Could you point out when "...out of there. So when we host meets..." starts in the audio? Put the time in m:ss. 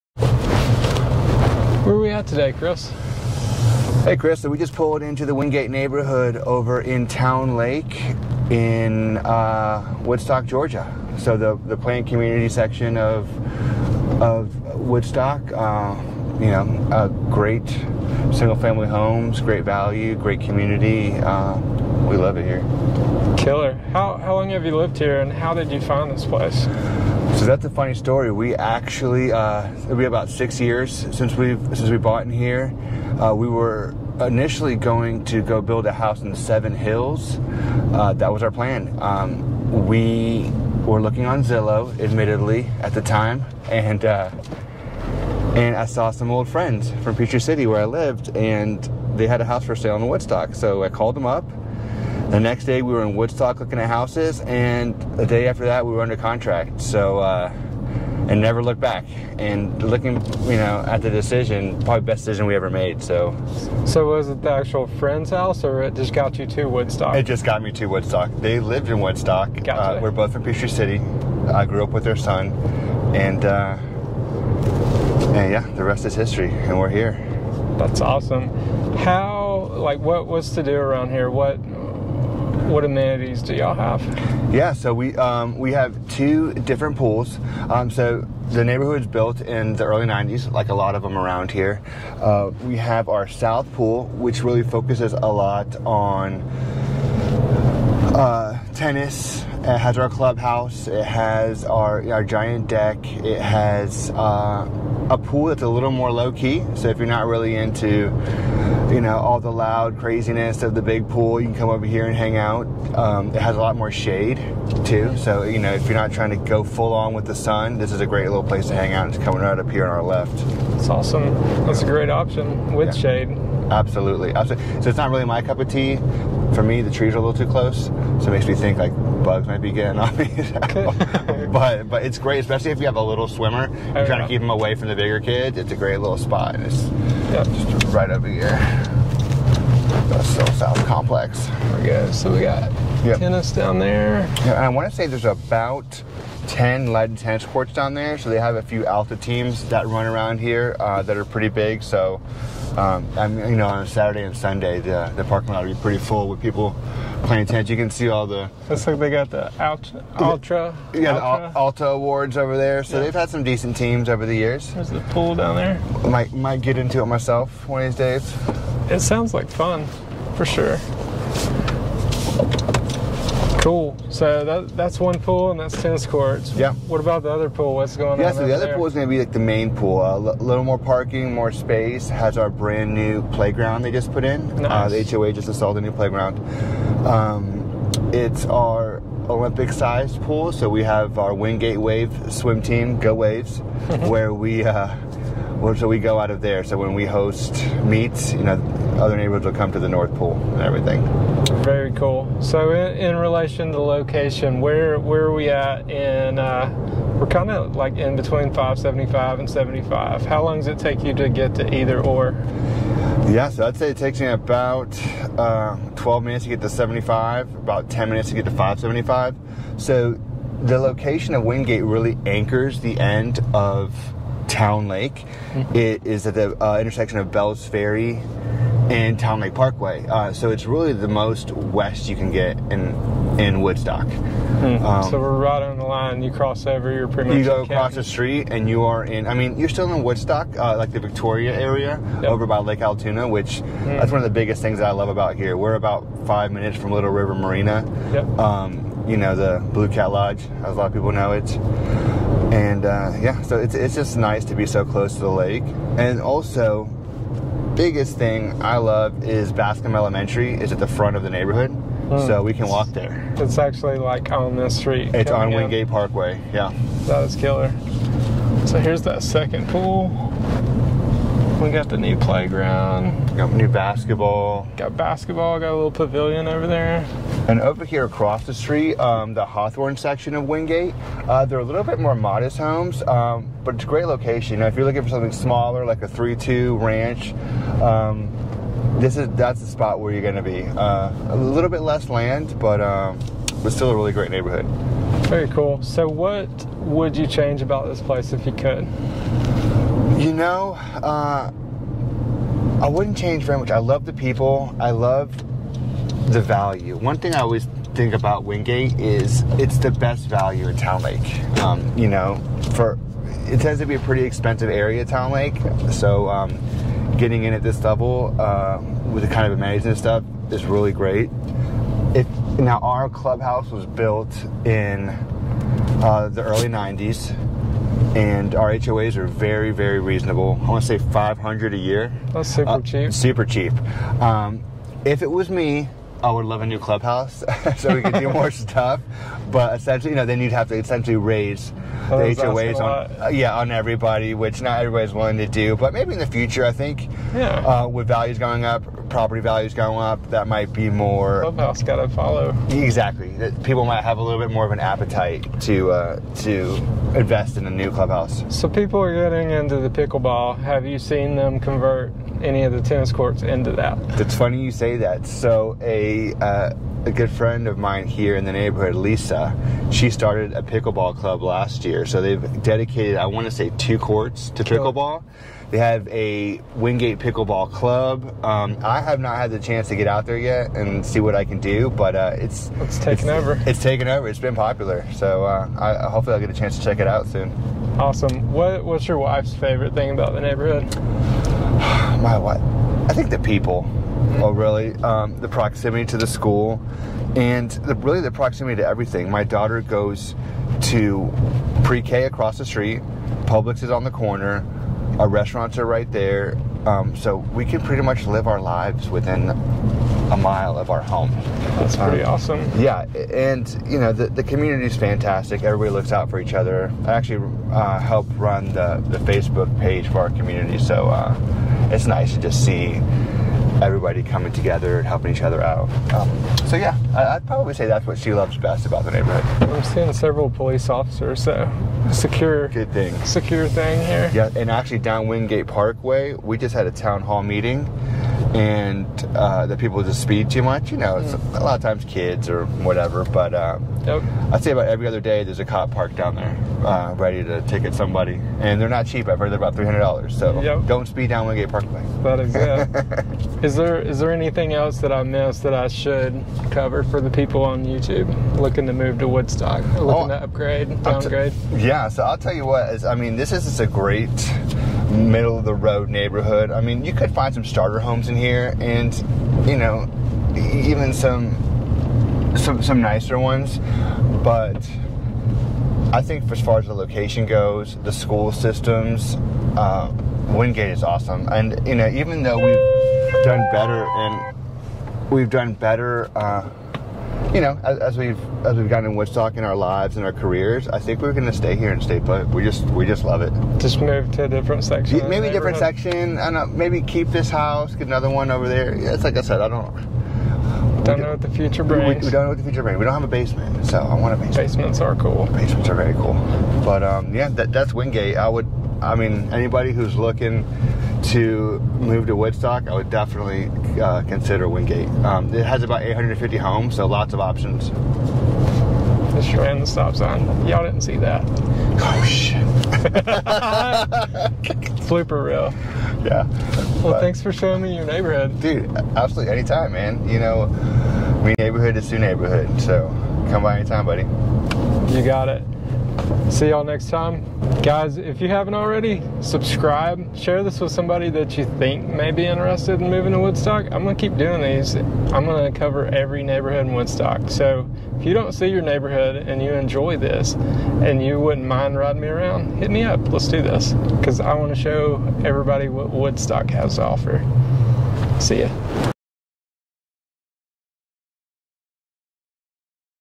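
3:16.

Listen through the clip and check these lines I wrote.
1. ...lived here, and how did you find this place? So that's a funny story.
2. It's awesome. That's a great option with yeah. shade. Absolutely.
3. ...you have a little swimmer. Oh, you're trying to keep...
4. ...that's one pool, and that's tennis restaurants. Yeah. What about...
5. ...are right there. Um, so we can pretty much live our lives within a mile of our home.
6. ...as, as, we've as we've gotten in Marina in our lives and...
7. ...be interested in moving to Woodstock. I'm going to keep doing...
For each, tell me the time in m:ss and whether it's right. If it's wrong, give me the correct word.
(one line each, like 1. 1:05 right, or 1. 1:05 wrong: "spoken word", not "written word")
1. 0:24 right
2. 2:00 right
3. 2:12 right
4. 2:54 wrong: "courts", not "restaurants"
5. 6:45 right
6. 8:07 wrong: "Woodstock", not "Marina"
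7. 9:02 right.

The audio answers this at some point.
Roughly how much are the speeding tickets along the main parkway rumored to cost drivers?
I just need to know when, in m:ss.
7:29.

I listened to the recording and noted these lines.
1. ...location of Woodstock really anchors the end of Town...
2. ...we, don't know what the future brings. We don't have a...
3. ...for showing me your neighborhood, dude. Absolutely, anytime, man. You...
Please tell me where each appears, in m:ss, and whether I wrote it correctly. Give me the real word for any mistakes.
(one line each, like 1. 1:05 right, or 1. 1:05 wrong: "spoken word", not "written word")
1. 3:40 wrong: "Wyngate", not "Woodstock"
2. 8:22 right
3. 8:47 right.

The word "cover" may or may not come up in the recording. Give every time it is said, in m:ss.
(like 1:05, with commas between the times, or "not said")
7:36, 9:05.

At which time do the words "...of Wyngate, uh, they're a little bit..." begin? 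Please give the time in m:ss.
4:40.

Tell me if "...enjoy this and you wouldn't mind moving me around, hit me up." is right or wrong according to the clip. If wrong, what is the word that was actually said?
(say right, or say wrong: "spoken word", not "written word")
wrong: "riding", not "moving".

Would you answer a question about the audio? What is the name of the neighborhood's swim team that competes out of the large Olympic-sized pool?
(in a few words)
Wyngate Wave.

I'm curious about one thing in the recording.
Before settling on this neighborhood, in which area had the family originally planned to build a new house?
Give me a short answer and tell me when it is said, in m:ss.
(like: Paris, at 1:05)
Seven Hills, at 0:36.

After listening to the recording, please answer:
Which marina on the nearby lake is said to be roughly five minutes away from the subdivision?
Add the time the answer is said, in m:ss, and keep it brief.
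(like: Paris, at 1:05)
Little River Marina, at 4:06.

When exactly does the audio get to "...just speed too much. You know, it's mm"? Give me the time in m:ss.
7:20.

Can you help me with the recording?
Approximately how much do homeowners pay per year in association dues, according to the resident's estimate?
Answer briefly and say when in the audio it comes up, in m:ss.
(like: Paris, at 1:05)
500, at 5:31.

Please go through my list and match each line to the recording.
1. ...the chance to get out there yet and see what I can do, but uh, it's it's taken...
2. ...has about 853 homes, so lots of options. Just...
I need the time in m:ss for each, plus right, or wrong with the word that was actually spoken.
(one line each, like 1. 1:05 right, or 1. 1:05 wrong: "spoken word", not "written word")
1. 6:19 right
2. 8:35 wrong: "850", not "853".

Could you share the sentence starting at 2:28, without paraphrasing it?
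So they have a few Alta teams that run around here uh, that are pretty big.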